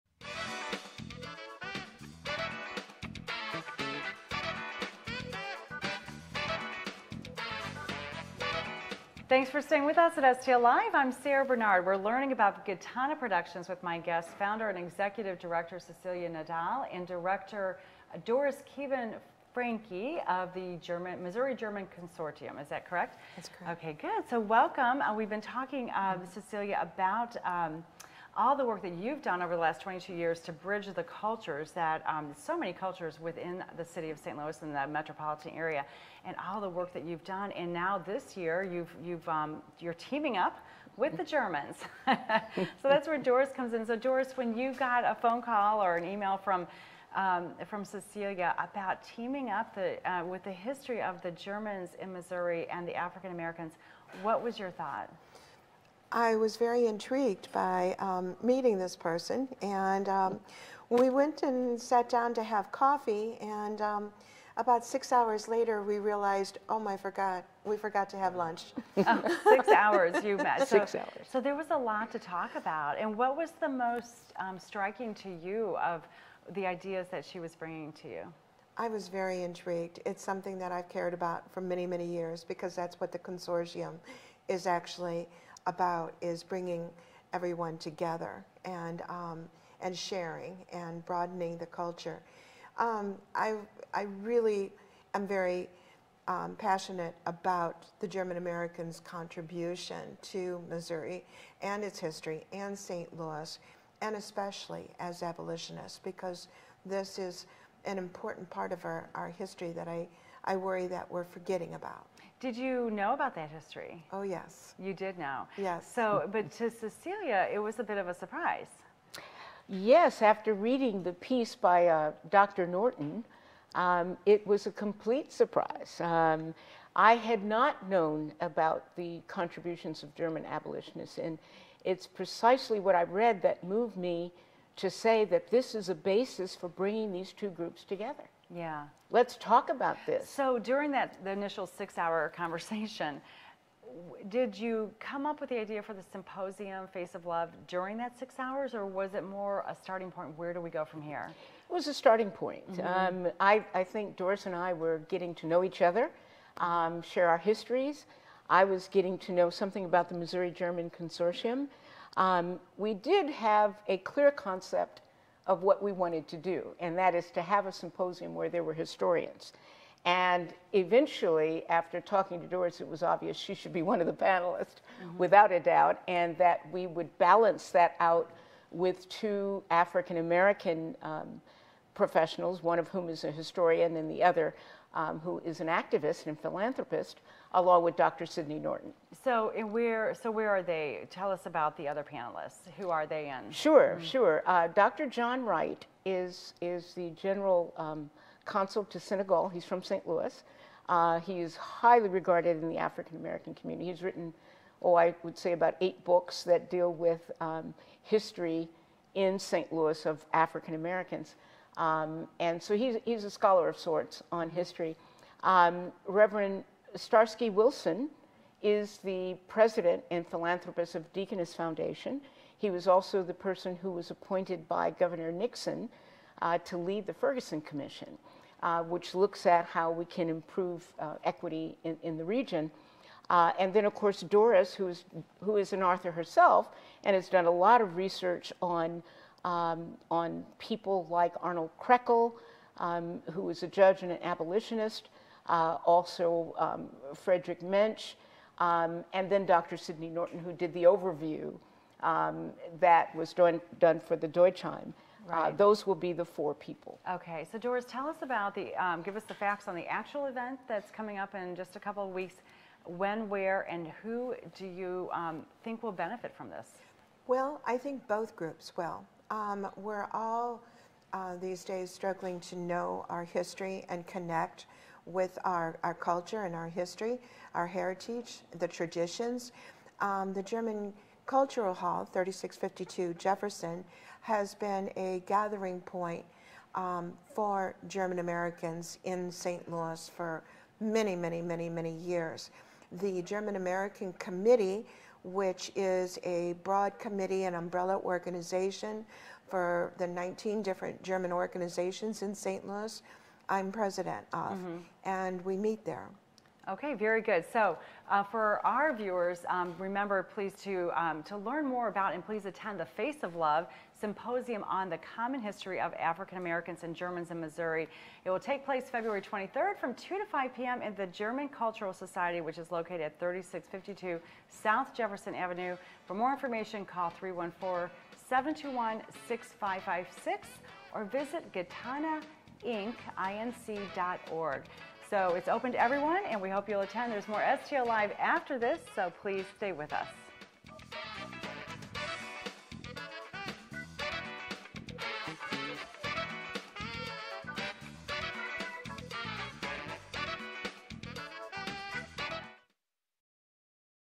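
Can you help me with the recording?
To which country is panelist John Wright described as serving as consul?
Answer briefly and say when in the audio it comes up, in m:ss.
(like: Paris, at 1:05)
Senegal, at 3:18.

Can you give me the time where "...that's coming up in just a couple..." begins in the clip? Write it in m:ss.
4:20.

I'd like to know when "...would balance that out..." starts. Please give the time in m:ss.
2:56.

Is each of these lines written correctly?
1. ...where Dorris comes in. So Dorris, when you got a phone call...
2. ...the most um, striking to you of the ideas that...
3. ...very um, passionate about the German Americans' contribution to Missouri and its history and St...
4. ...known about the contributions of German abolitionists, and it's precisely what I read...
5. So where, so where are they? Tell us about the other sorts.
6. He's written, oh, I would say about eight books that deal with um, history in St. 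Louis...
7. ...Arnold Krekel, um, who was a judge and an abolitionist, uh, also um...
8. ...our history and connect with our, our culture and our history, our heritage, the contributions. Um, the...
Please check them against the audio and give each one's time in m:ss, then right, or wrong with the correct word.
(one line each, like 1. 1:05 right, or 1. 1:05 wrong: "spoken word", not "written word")
1. 0:43 right
2. 1:13 right
3. 1:35 right
4. 2:07 right
5. 3:09 wrong: "panelists", not "sorts"
6. 3:23 right
7. 4:01 right
8. 4:33 wrong: "traditions", not "contributions".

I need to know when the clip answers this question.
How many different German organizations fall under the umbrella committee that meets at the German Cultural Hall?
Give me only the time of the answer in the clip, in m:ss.
5:00.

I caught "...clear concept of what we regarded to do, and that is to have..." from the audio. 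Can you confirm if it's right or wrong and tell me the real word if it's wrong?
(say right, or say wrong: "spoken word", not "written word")
wrong: "wanted", not "regarded".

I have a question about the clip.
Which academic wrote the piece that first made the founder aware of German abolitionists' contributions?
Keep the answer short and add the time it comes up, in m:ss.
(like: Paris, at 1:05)
Dr. Norton, at 2:02.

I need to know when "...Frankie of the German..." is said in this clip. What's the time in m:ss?
0:19.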